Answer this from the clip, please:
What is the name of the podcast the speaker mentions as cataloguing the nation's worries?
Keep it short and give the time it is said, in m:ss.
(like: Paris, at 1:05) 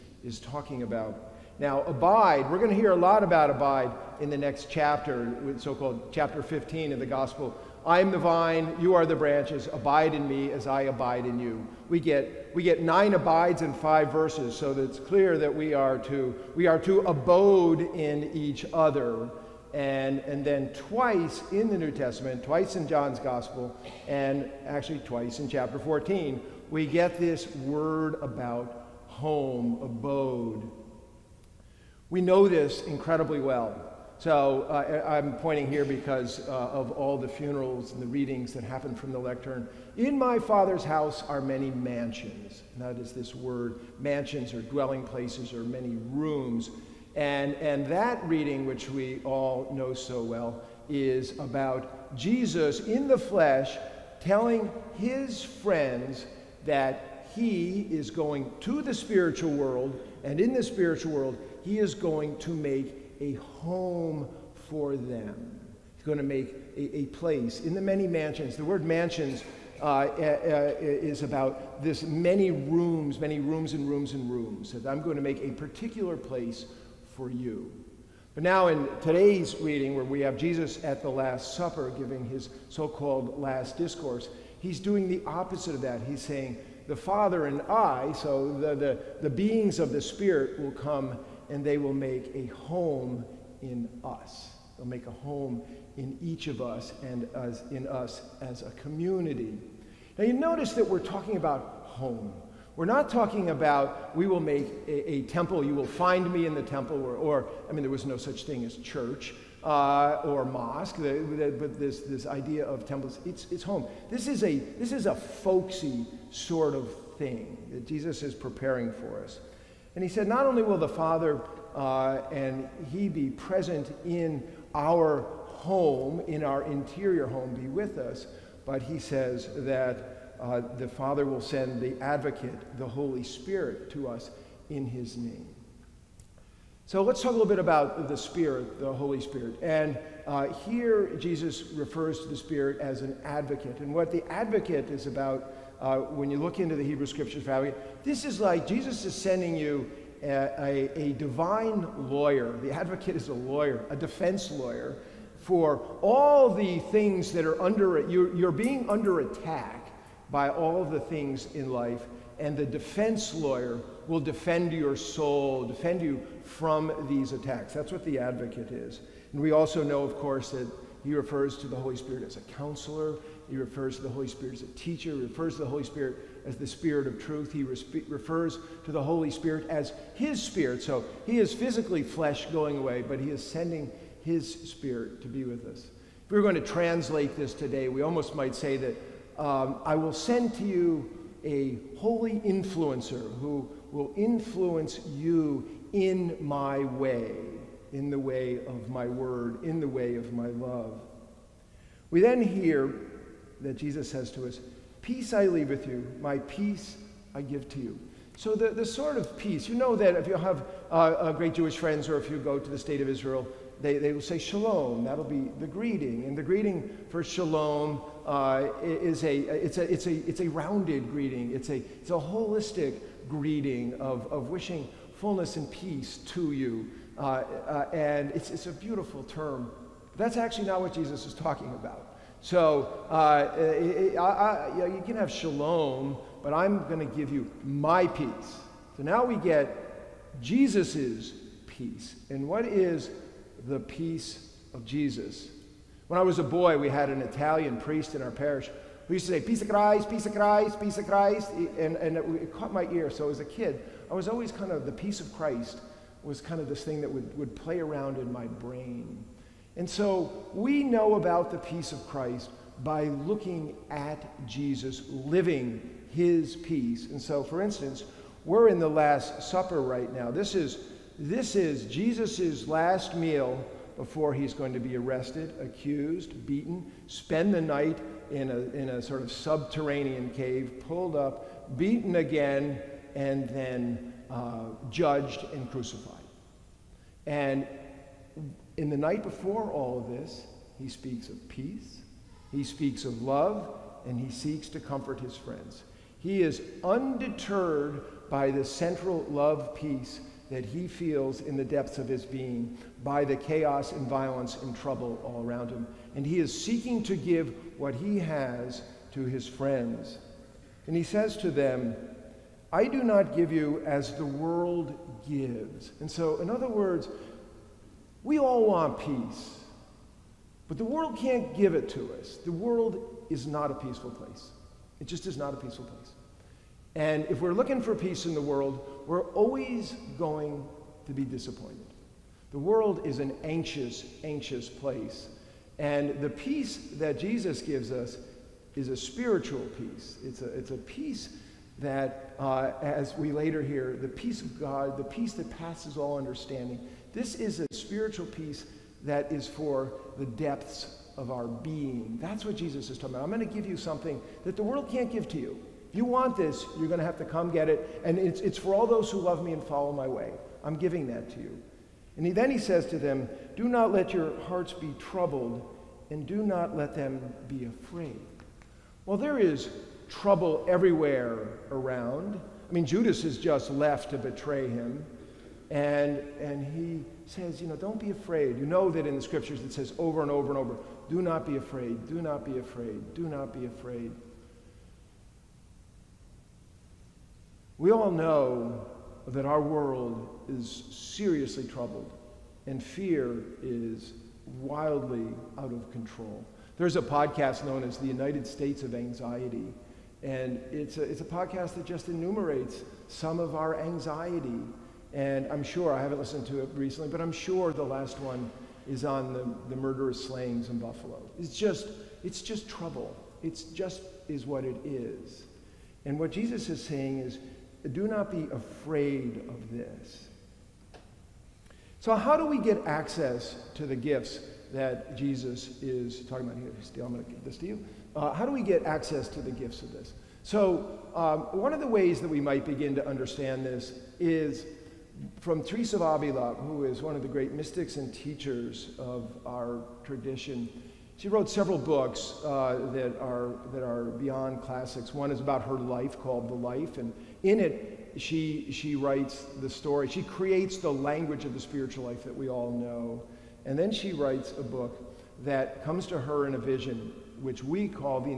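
United States of Anxiety, at 6:38.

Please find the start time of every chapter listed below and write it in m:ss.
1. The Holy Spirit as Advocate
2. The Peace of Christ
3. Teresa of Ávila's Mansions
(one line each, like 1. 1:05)
1. 2:15
2. 3:20
3. 7:00.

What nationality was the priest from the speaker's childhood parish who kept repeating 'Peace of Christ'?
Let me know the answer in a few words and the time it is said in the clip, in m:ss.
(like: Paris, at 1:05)
Italian, at 4:07.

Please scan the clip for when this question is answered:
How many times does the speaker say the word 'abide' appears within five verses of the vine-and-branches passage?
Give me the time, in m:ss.
0:12.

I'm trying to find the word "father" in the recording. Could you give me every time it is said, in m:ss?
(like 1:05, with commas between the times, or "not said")
0:40, 1:26, 2:00, 2:10.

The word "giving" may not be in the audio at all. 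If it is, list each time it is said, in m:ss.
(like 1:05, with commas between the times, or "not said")
1:21, 6:00.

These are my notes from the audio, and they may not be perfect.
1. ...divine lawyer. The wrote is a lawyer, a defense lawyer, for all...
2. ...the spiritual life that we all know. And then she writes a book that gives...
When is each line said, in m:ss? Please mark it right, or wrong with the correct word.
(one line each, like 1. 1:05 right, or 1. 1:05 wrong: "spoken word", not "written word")
1. 2:31 wrong: "advocate", not "wrote"
2. 7:31 wrong: "comes", not "gives".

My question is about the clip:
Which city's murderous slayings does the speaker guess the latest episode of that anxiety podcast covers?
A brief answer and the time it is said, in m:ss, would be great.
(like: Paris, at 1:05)
Buffalo, at 6:50.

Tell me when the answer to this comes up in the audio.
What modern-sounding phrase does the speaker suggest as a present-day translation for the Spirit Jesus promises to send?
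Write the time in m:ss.
3:11.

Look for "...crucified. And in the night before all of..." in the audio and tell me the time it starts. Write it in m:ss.
4:45.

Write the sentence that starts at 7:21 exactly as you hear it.
She wrote several books uh, that, are, that are beyond classics.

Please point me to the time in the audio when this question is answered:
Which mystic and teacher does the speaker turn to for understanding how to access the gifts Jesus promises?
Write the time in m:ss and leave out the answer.
7:15.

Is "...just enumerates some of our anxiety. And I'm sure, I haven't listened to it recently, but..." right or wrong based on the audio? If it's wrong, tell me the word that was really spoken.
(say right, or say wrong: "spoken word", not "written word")
right.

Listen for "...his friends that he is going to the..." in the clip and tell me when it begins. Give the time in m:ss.
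0:54.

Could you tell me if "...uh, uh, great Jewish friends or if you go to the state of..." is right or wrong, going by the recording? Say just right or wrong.
right.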